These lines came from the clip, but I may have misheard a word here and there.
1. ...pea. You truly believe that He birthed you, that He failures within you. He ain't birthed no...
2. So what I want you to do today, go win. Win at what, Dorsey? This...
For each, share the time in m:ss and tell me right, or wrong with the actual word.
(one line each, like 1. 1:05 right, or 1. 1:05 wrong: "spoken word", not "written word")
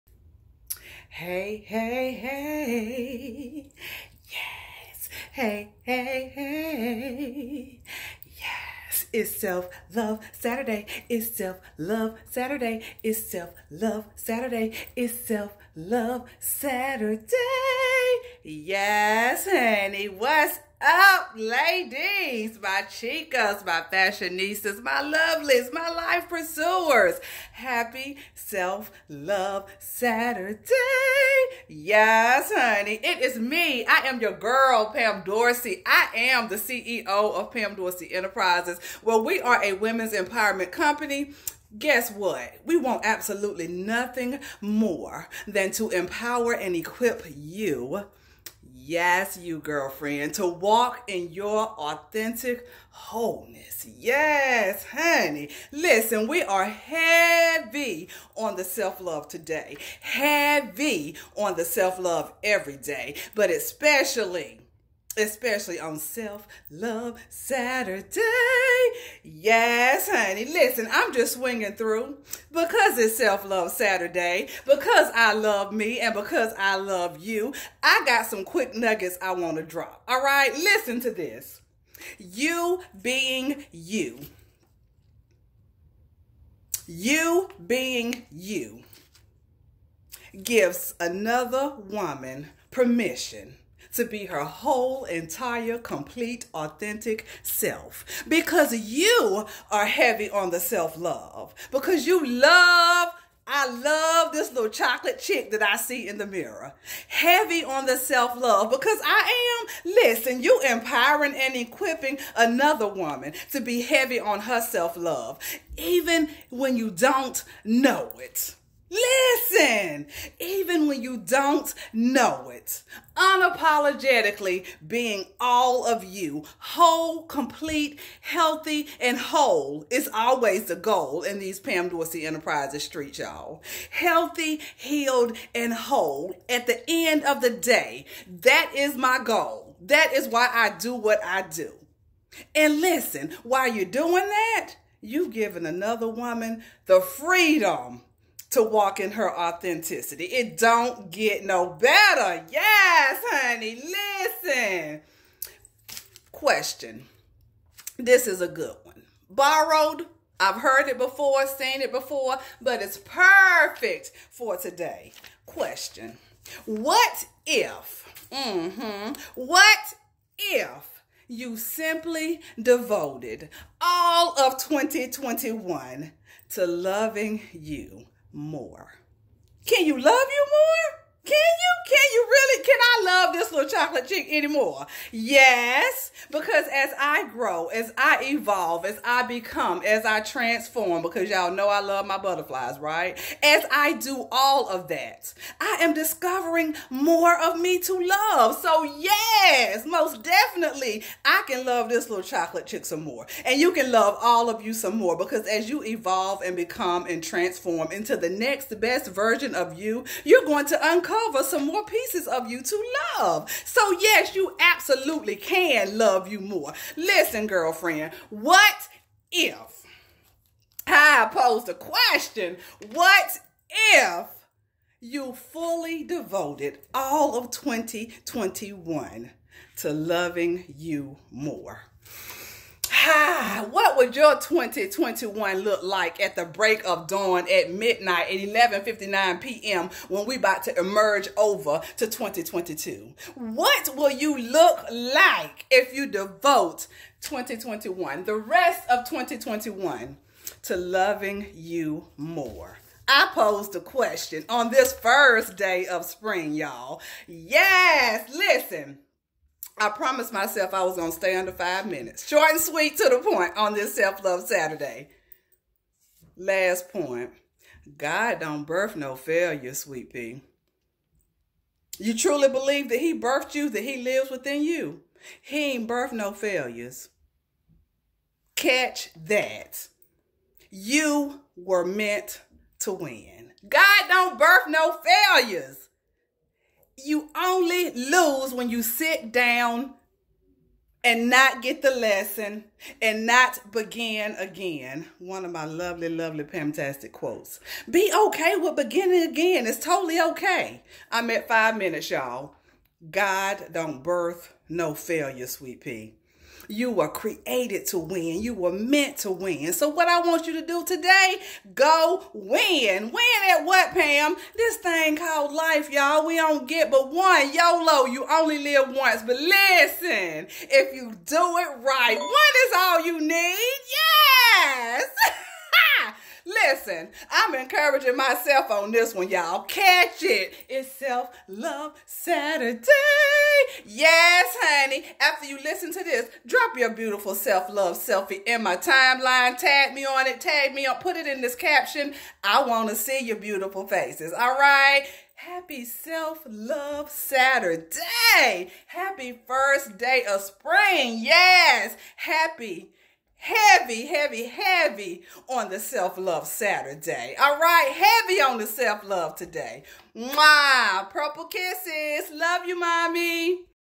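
1. 4:30 wrong: "lives", not "failures"
2. 5:09 wrong: "Pam", not "Dorsey".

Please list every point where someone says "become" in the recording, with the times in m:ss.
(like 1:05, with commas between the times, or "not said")
3:09, 3:26.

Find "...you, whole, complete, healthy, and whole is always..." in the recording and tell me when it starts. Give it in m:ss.
2:06.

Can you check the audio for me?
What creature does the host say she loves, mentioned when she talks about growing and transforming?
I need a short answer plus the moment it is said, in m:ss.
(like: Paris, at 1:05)
Butterflies, at 3:12.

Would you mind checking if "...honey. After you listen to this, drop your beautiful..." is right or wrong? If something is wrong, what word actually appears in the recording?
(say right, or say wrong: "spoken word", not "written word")
right.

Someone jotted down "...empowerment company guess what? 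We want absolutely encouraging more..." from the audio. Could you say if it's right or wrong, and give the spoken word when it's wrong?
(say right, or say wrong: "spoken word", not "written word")
wrong: "nothing", not "encouraging".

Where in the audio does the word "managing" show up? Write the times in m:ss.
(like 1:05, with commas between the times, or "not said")
not said.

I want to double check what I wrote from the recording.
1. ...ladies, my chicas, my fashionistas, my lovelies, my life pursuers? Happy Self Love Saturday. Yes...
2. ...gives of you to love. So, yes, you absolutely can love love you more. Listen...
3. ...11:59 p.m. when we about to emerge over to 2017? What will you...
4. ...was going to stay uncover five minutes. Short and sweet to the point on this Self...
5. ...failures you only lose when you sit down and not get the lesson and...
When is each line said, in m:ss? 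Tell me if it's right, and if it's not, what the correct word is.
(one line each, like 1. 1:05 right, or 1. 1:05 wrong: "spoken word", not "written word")
1. 0:21 right
2. 3:31 wrong: "pieces", not "gives"
3. 3:58 wrong: "2022", not "2017"
4. 4:20 wrong: "under", not "uncover"
5. 4:45 right.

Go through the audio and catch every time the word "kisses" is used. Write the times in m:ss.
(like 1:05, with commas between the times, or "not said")
6:01.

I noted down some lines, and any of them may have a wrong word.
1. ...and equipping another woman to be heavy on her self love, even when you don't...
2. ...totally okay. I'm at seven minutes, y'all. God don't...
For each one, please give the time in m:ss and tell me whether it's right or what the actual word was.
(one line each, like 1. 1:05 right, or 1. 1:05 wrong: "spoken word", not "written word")
1. 1:51 right
2. 4:59 wrong: "five", not "seven".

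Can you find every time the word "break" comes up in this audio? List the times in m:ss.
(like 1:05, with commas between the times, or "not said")
3:56.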